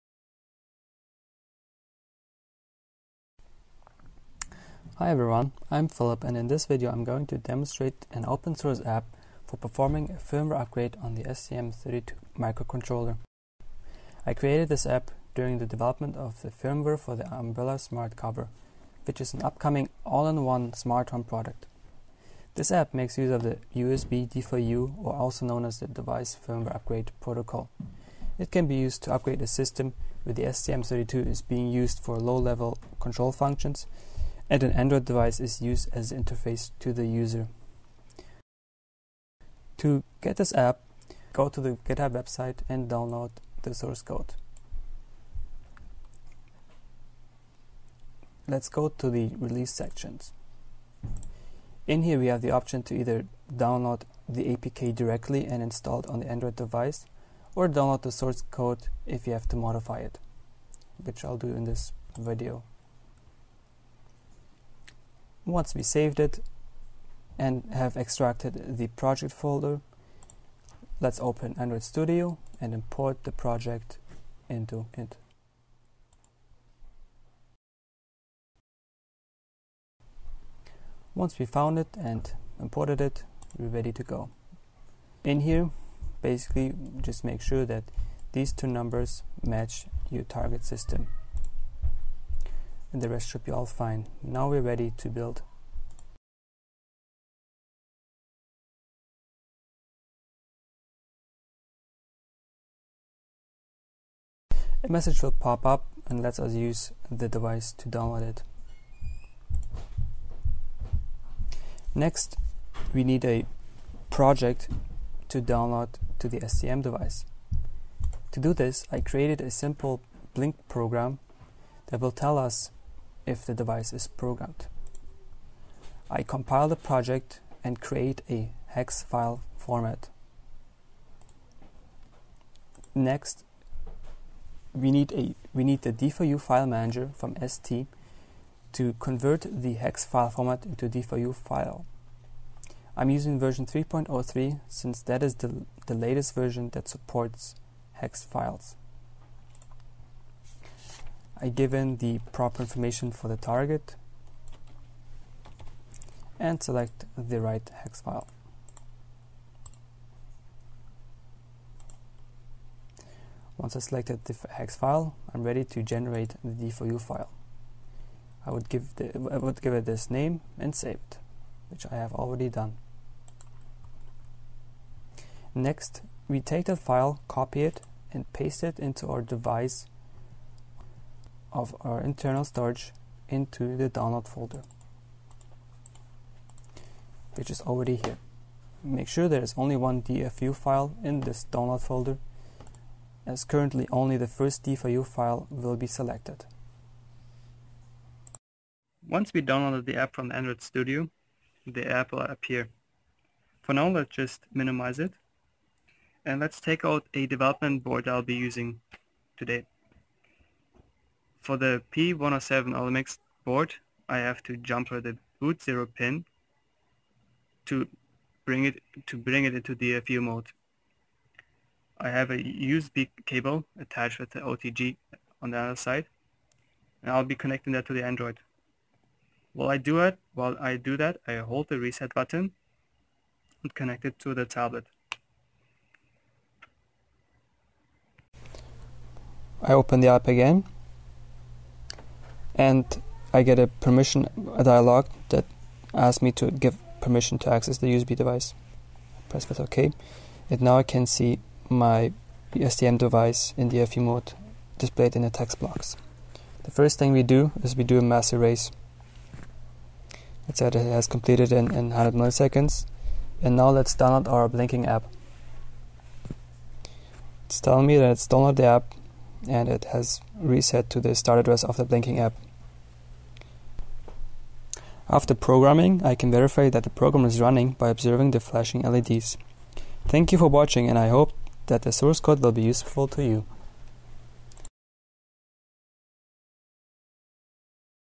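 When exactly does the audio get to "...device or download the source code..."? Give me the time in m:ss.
0:56.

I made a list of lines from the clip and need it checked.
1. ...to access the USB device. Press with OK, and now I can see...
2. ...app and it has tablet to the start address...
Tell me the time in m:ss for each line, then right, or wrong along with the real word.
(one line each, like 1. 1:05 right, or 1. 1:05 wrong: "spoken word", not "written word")
1. 4:07 right
2. 4:28 wrong: "reset", not "tablet".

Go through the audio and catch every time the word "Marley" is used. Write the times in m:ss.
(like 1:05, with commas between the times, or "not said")
not said.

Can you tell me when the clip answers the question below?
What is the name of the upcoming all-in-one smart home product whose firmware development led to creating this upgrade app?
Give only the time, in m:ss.
0:17.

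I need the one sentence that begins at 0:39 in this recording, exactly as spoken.
To get this app, go to the GitHub website and download the source code.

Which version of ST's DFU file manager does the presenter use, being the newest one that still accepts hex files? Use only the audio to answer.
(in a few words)
3.03.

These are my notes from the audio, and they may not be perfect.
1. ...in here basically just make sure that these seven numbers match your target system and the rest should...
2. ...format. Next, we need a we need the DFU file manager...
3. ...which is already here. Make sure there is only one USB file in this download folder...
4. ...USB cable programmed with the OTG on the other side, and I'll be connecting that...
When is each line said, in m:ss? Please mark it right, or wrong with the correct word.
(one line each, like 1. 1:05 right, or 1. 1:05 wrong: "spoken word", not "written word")
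1. 1:25 wrong: "two", not "seven"
2. 2:09 right
3. 3:07 wrong: "DFU", not "USB"
4. 3:42 wrong: "attached", not "programmed".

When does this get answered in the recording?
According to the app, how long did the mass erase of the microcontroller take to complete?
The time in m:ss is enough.
4:21.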